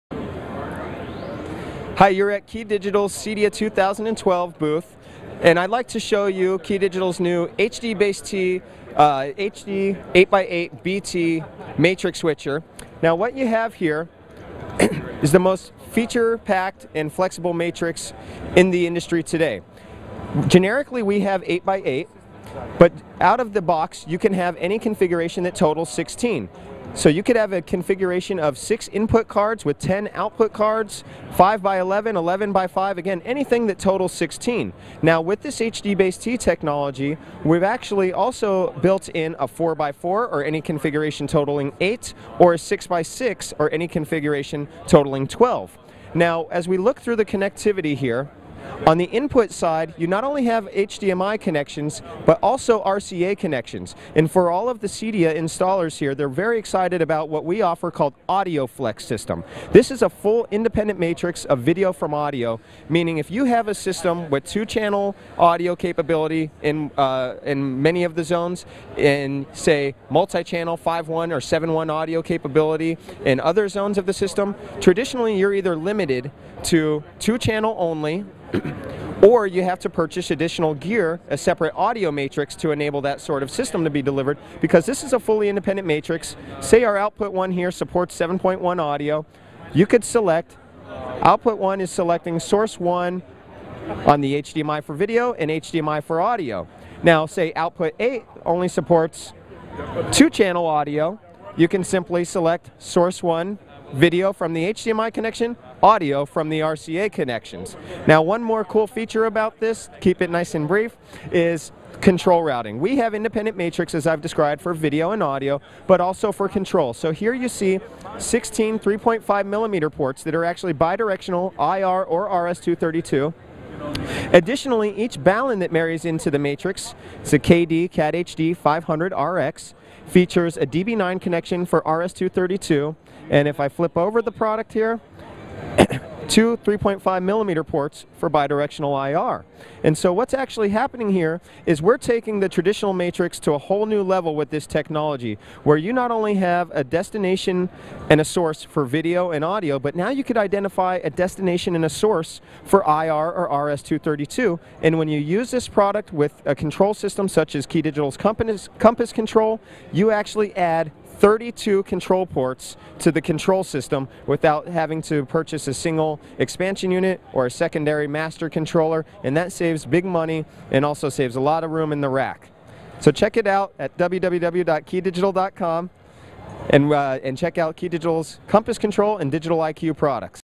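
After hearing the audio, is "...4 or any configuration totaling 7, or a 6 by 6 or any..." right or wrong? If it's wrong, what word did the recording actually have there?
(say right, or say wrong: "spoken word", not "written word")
wrong: "8", not "7".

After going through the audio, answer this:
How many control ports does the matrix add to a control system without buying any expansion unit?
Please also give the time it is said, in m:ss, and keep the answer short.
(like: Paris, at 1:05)
32, at 2:41.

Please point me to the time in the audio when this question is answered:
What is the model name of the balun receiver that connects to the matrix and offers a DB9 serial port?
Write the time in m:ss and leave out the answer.
2:07.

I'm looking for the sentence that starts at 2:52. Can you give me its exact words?
So check it out at www.keydigital.com and, uh, and check out Key Digital's Compass Control and Digital IQ products.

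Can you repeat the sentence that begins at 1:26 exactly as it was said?
Say our output one here supports 7.1 audio.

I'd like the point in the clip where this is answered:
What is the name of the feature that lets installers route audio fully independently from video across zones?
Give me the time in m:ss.
0:58.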